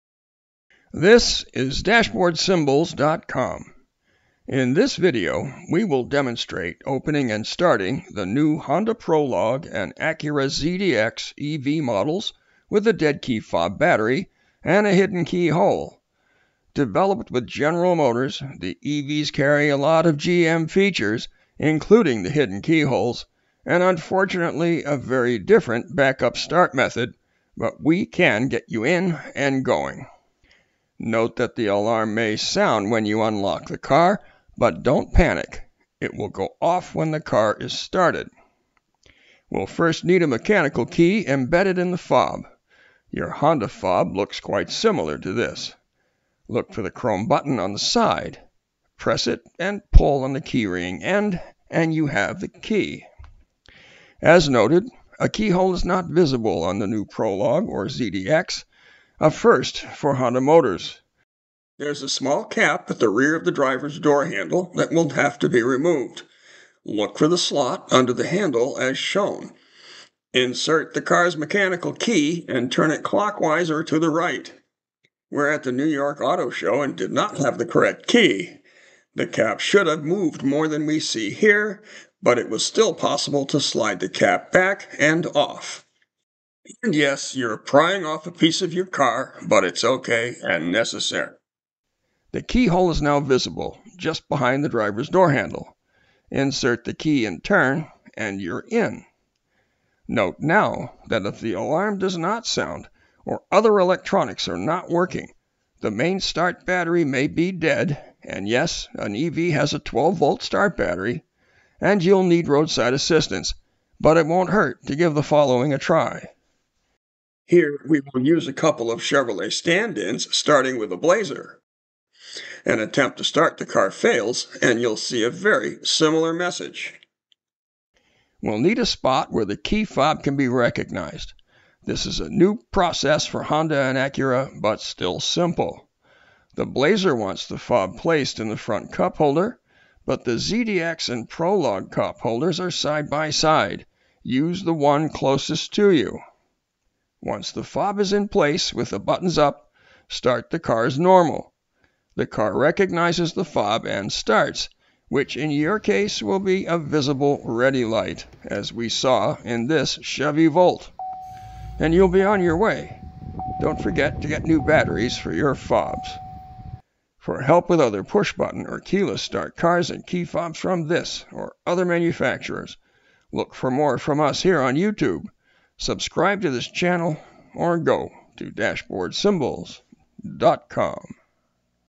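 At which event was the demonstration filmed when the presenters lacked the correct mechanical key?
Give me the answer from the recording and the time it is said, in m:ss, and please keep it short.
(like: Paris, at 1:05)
New York Auto Show, at 1:15.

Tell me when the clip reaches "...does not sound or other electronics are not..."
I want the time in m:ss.
1:41.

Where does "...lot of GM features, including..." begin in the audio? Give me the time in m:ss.
0:19.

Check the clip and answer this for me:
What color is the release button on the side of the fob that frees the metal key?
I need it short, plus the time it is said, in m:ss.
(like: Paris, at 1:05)
Chrome, at 0:46.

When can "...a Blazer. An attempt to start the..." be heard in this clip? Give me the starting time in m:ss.
2:00.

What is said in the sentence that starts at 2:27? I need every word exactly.
Once the fob is in place with the buttons up, start the car as normal.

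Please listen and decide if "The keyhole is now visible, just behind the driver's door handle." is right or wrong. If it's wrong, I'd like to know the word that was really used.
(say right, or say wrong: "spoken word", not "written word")
right.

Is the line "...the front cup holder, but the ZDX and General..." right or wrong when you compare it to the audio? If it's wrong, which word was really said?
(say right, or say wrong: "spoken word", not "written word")
wrong: "Prologue", not "General".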